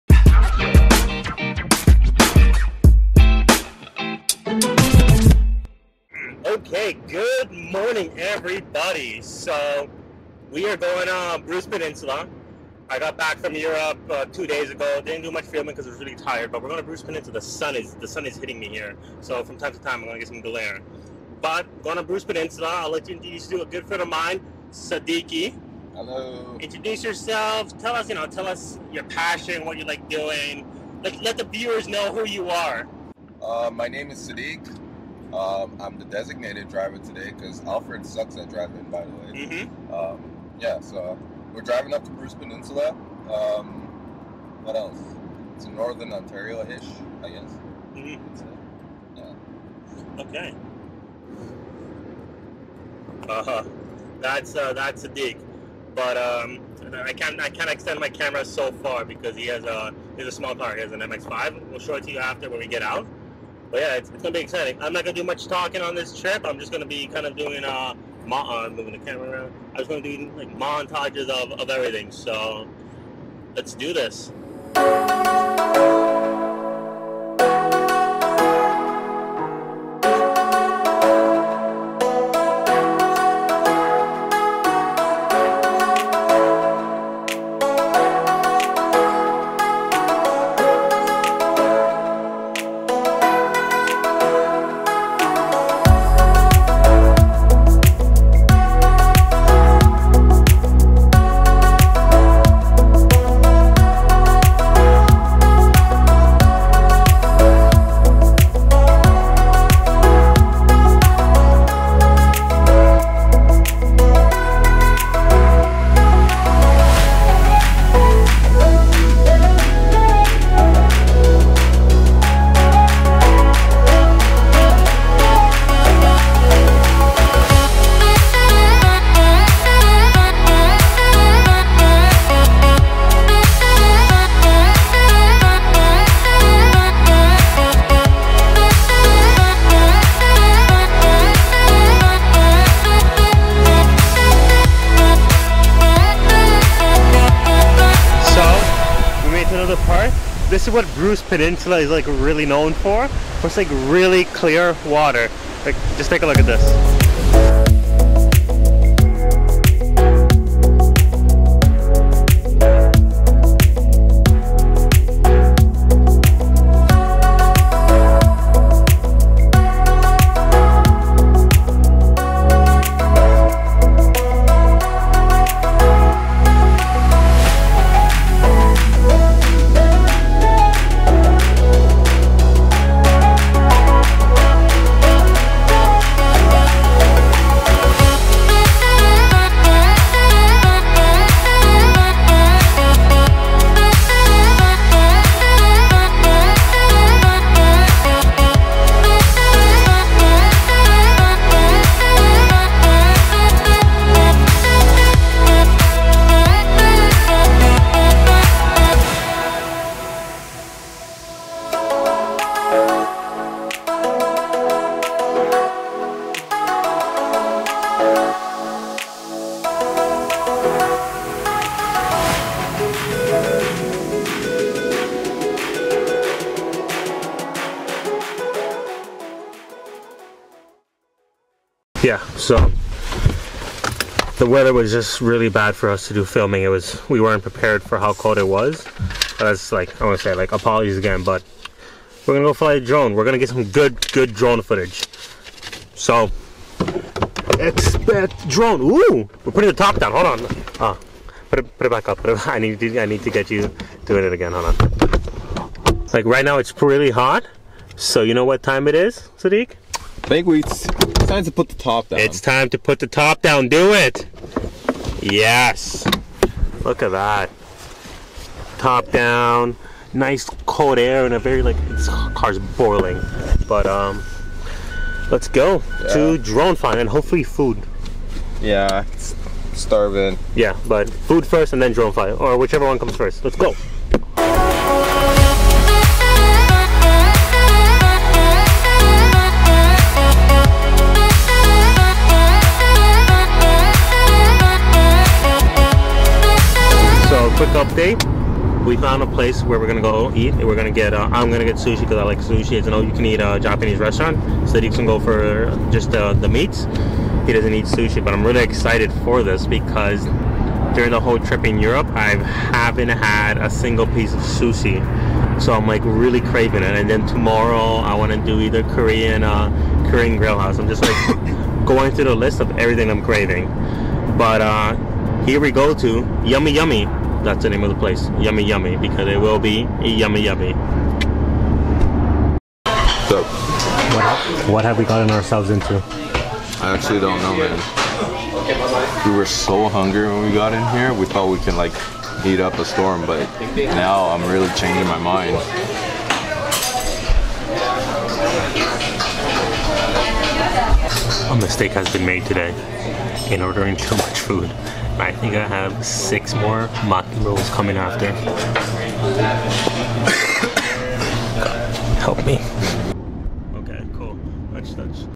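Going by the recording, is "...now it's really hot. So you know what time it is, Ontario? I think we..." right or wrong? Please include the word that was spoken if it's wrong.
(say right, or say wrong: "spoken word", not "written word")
wrong: "Sadiq", not "Ontario".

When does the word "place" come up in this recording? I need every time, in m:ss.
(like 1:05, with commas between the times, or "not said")
4:59, 5:27.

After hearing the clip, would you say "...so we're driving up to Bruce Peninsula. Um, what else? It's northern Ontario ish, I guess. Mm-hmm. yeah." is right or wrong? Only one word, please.
right.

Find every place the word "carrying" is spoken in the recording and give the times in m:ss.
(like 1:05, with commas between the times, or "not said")
not said.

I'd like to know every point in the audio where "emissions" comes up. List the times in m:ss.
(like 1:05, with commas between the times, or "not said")
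not said.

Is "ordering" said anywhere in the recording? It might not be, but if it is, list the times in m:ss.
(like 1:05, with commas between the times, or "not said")
5:53.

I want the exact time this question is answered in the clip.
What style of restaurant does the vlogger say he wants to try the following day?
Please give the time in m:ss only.
5:20.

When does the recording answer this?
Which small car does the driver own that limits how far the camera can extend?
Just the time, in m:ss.
1:00.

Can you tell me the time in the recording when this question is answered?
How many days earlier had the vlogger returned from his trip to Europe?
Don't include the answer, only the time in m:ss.
0:14.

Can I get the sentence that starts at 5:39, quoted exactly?
We were so hungry when we got in here.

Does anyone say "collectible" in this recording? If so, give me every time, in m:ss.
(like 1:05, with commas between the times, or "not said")
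not said.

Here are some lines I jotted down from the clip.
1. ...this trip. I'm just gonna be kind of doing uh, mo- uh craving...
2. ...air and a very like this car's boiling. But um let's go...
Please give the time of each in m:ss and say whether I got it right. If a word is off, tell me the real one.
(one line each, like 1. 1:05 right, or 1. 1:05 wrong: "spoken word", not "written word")
1. 1:05 wrong: "moving", not "craving"
2. 4:30 right.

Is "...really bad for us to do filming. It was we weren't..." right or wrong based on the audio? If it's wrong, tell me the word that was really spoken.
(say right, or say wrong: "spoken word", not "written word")
right.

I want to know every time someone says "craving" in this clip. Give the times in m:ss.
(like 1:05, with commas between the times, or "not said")
5:16, 5:23.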